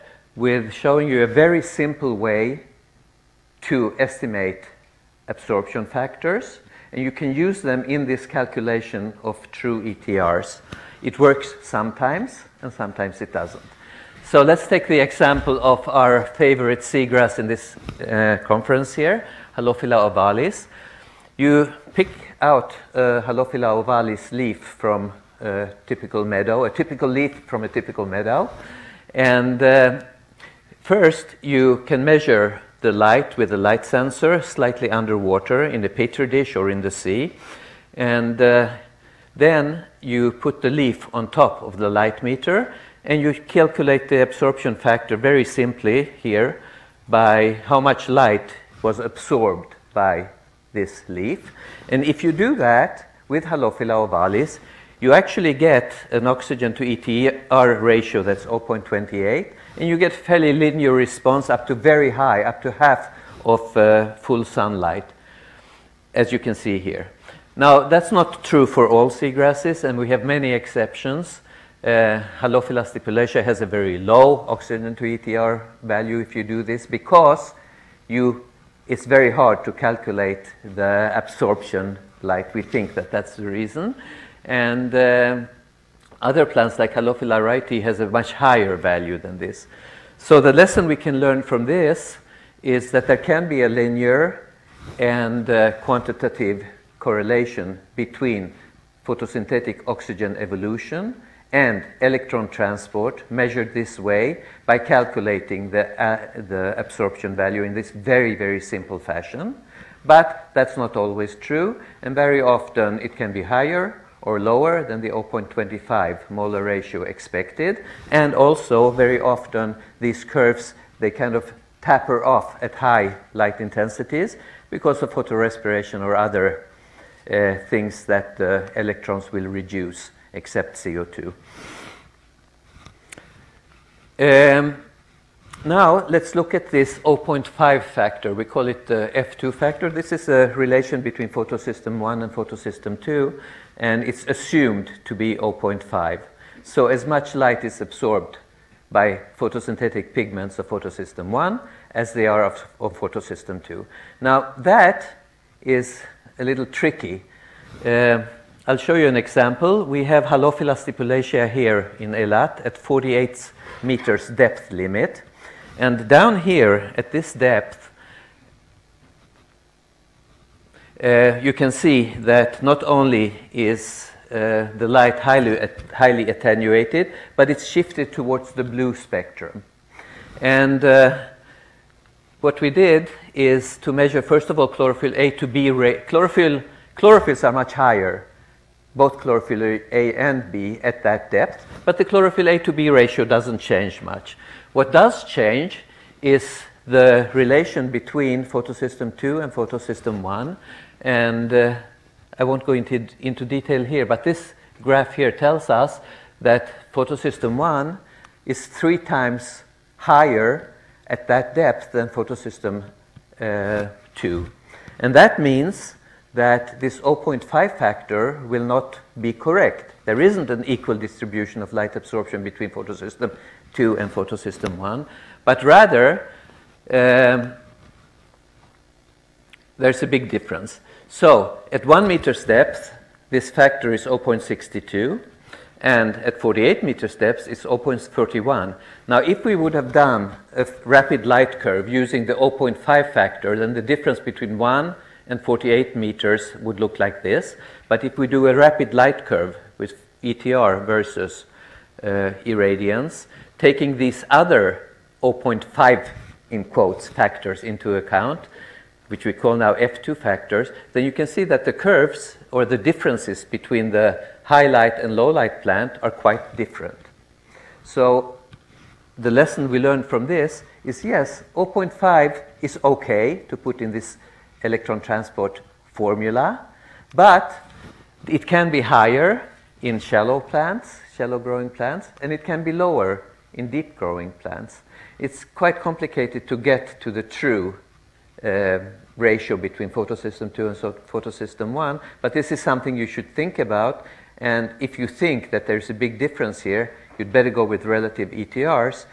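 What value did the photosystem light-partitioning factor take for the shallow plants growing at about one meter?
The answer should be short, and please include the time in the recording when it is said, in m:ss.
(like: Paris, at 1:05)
0.62, at 3:54.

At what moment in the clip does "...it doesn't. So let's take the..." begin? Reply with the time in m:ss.
0:13.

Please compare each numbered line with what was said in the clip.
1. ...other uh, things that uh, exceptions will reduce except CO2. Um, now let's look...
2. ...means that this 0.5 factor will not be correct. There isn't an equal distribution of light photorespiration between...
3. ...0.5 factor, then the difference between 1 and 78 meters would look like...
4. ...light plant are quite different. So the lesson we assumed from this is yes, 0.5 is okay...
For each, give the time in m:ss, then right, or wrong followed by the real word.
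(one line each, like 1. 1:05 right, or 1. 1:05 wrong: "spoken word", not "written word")
1. 2:06 wrong: "electrons", not "exceptions"
2. 3:35 wrong: "absorption", not "photorespiration"
3. 4:02 wrong: "48", not "78"
4. 4:25 wrong: "learned", not "assumed".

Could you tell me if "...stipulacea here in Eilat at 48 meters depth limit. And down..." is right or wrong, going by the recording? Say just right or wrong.
right.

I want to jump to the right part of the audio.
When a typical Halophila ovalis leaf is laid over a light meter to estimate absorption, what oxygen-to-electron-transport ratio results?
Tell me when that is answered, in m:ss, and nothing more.
0:58.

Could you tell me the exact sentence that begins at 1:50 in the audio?
But that's not always true, and very often it can be higher or lower than the 0.25 molar ratio expected.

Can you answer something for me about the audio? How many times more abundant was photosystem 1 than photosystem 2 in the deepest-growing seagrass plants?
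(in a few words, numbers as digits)
3 times.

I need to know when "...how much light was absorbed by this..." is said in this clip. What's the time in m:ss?
0:47.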